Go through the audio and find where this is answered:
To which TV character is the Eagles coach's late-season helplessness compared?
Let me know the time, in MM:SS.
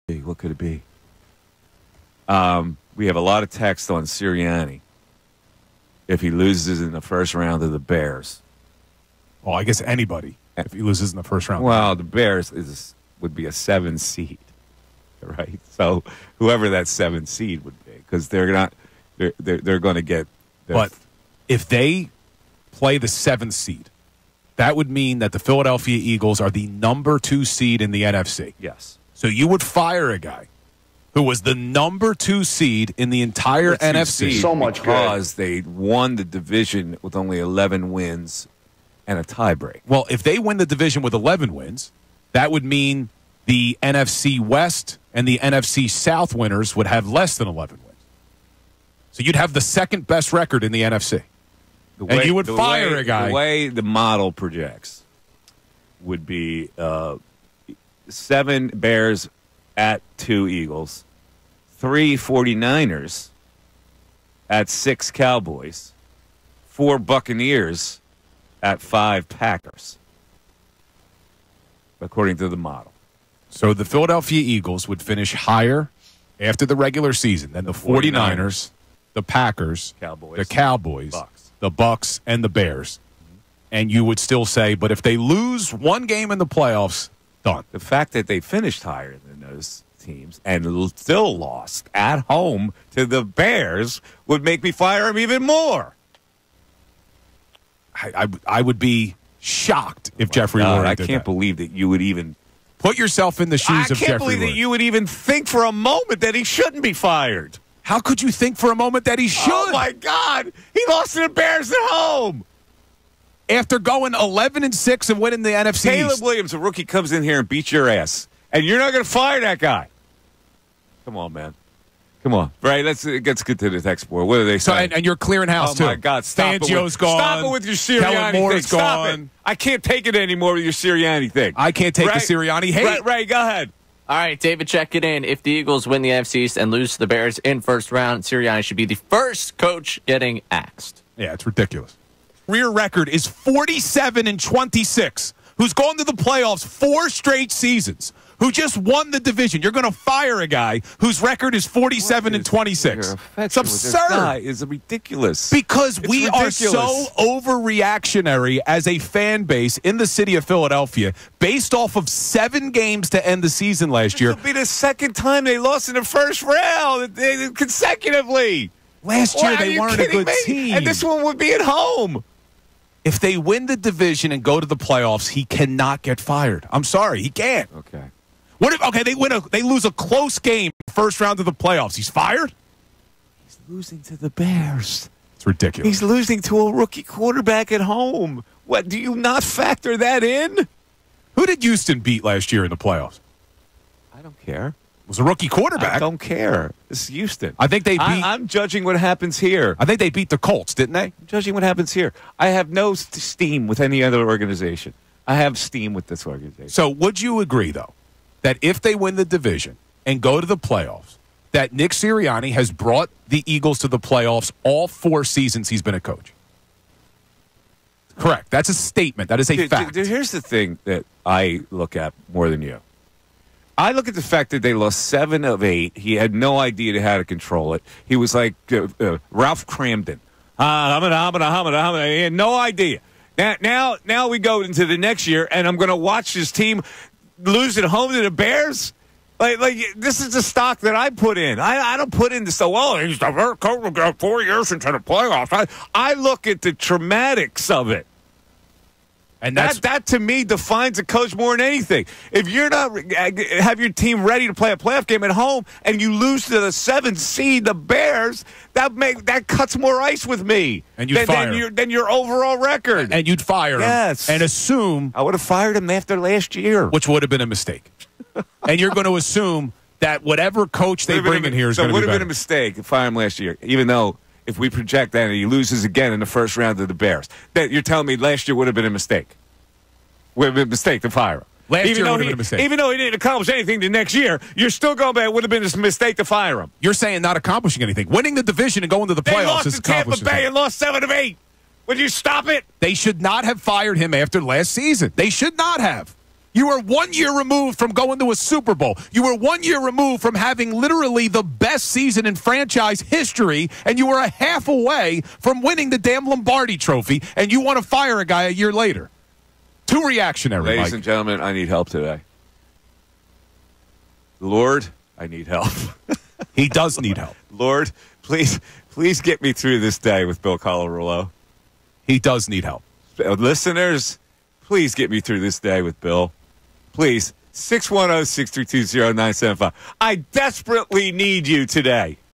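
03:49.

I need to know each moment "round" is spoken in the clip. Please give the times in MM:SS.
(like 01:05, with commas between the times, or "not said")
00:07, 00:11, 02:17, 02:46, 03:01, 04:36.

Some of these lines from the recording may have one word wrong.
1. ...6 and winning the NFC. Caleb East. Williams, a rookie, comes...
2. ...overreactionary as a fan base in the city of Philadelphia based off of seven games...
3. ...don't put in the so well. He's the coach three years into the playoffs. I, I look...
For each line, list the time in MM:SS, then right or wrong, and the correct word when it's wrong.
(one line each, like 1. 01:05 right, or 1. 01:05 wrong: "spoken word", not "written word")
1. 01:54 right
2. 02:37 right
3. 04:01 wrong: "four", not "three".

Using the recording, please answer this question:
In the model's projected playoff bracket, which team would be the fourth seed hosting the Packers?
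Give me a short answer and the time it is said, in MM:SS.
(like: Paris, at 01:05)
Buccaneers, at 01:06.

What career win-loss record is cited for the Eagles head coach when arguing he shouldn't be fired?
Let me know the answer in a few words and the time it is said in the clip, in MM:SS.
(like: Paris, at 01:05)
47 and 26, at 02:23.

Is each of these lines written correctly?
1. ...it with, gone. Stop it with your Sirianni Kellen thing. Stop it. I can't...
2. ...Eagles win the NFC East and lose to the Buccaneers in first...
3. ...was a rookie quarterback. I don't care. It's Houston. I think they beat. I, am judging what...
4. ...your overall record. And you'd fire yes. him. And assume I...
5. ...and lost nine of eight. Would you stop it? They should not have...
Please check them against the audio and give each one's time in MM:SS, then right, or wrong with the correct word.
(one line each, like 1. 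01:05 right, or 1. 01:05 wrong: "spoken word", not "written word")
1. 02:06 right
2. 02:15 wrong: "Bears", not "Buccaneers"
3. 03:15 right
4. 04:21 right
5. 04:50 wrong: "seven", not "nine".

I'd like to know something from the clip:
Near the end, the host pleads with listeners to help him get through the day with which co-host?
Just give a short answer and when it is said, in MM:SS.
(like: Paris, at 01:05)
Bill Colarulo, at 05:20.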